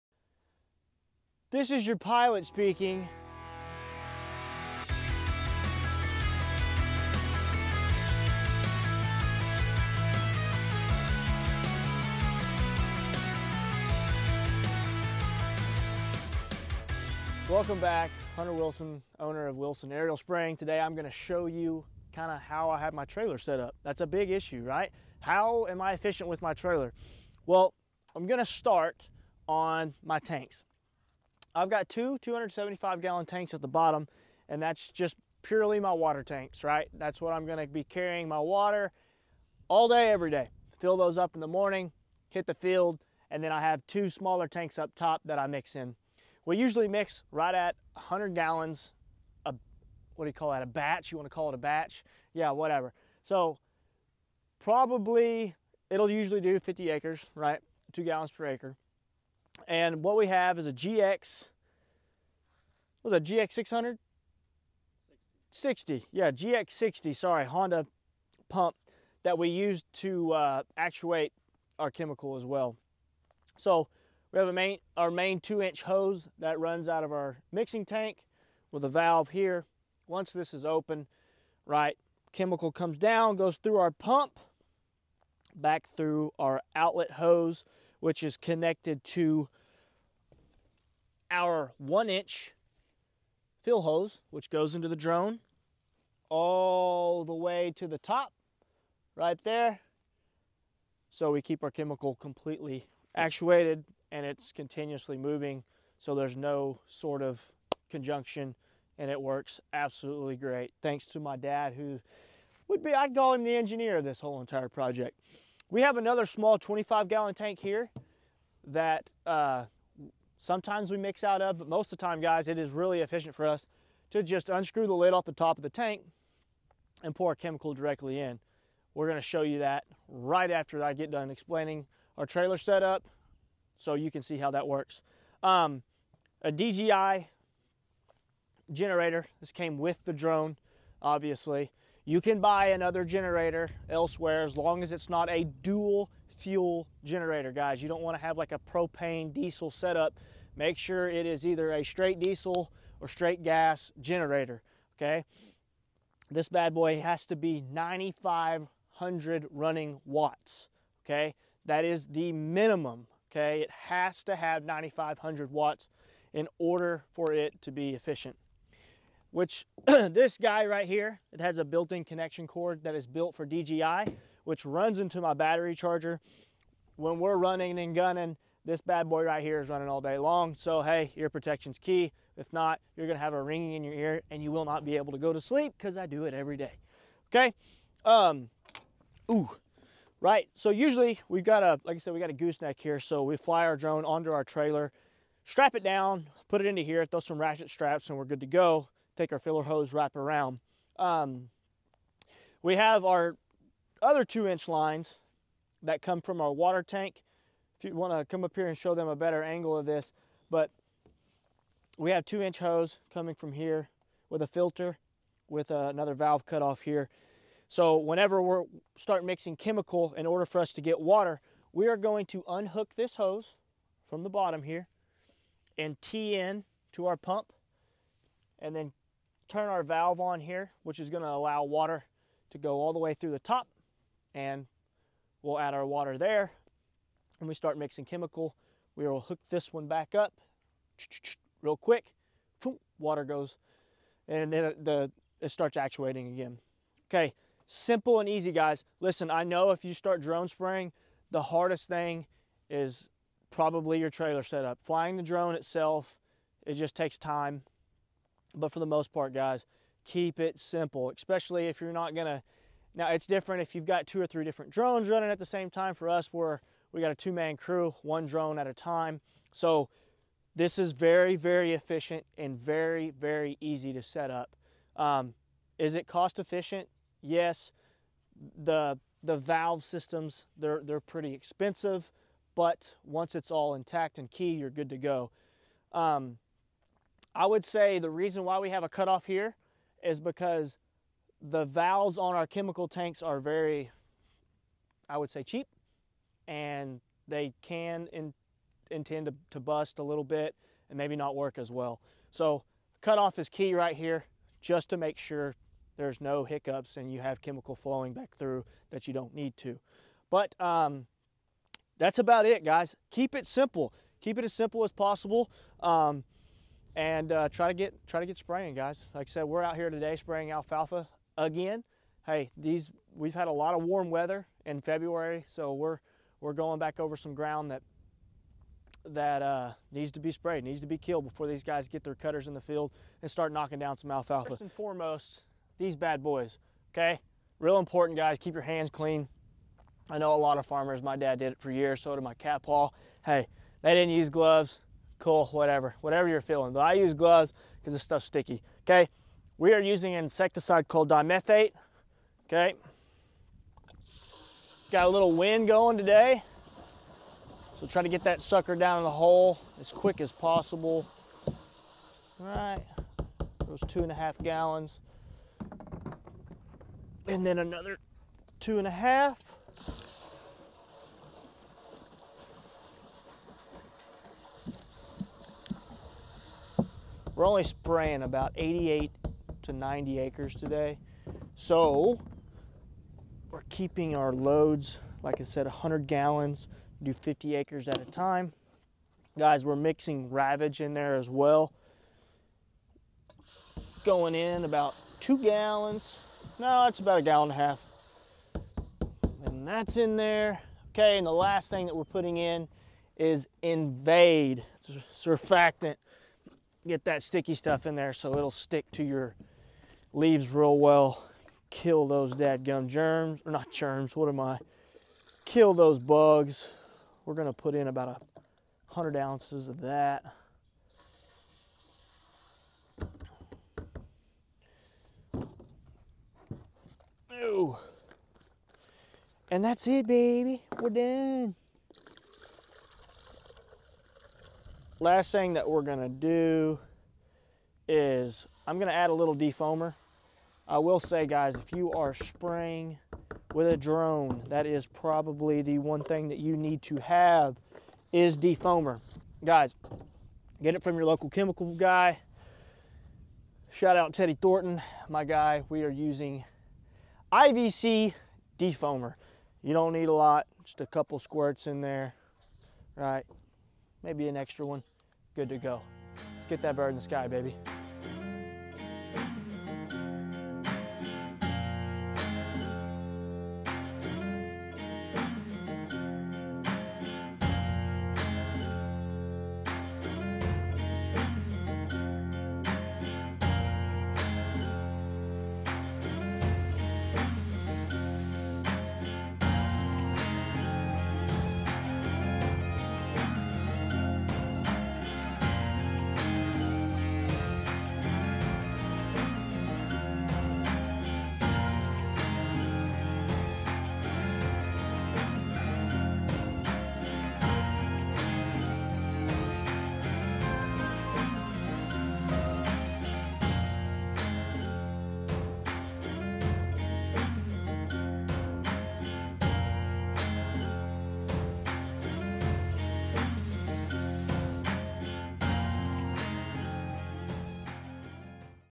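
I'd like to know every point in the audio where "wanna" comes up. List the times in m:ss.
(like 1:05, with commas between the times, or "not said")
0:51, 3:27.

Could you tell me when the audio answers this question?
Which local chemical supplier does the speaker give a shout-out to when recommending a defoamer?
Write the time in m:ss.
7:34.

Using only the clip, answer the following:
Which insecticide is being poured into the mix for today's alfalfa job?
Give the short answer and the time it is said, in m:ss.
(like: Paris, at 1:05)
dimethoate, at 5:51.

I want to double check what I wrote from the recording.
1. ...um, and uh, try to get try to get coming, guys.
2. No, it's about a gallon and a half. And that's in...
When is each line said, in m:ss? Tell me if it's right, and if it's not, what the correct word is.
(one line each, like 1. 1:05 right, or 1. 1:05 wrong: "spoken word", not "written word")
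1. 5:15 wrong: "spraying", not "coming"
2. 6:36 right.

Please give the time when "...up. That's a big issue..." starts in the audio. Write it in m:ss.
0:23.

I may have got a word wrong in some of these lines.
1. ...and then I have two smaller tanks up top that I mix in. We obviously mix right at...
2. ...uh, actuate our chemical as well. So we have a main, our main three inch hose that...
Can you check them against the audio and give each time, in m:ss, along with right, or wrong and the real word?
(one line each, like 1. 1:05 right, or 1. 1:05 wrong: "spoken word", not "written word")
1. 0:43 wrong: "usually", not "obviously"
2. 1:10 wrong: "two", not "three".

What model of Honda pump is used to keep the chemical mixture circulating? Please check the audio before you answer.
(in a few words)
GX 60.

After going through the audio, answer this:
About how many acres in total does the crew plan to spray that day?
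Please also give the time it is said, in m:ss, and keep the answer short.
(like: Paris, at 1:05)
88 to 90 acres, at 6:18.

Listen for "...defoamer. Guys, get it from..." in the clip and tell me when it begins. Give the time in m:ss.
7:28.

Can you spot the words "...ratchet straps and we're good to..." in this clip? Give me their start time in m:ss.
3:17.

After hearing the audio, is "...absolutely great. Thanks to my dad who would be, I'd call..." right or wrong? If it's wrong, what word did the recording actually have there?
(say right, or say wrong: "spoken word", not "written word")
right.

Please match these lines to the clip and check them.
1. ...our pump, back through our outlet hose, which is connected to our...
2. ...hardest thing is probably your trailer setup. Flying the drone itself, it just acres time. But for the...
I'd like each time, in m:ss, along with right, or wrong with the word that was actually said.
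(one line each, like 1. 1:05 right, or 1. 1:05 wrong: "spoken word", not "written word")
1. 1:23 right
2. 4:11 wrong: "takes", not "acres".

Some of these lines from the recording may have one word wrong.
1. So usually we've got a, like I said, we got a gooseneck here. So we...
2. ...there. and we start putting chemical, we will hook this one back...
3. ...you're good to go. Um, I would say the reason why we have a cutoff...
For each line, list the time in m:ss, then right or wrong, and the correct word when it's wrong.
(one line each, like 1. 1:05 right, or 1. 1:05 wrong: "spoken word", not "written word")
1. 3:10 right
2. 3:56 wrong: "mixing", not "putting"
3. 4:44 right.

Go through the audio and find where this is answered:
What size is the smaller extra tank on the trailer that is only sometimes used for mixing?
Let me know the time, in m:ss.
1:56.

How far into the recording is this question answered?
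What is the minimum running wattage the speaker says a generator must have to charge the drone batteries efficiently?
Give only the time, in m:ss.
2:37.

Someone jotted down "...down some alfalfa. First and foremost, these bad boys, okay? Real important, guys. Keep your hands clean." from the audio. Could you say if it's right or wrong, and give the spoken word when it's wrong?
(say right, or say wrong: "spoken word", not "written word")
right.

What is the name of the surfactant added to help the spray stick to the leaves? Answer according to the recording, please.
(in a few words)
Invade.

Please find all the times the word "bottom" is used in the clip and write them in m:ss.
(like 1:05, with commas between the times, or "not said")
0:33, 3:44.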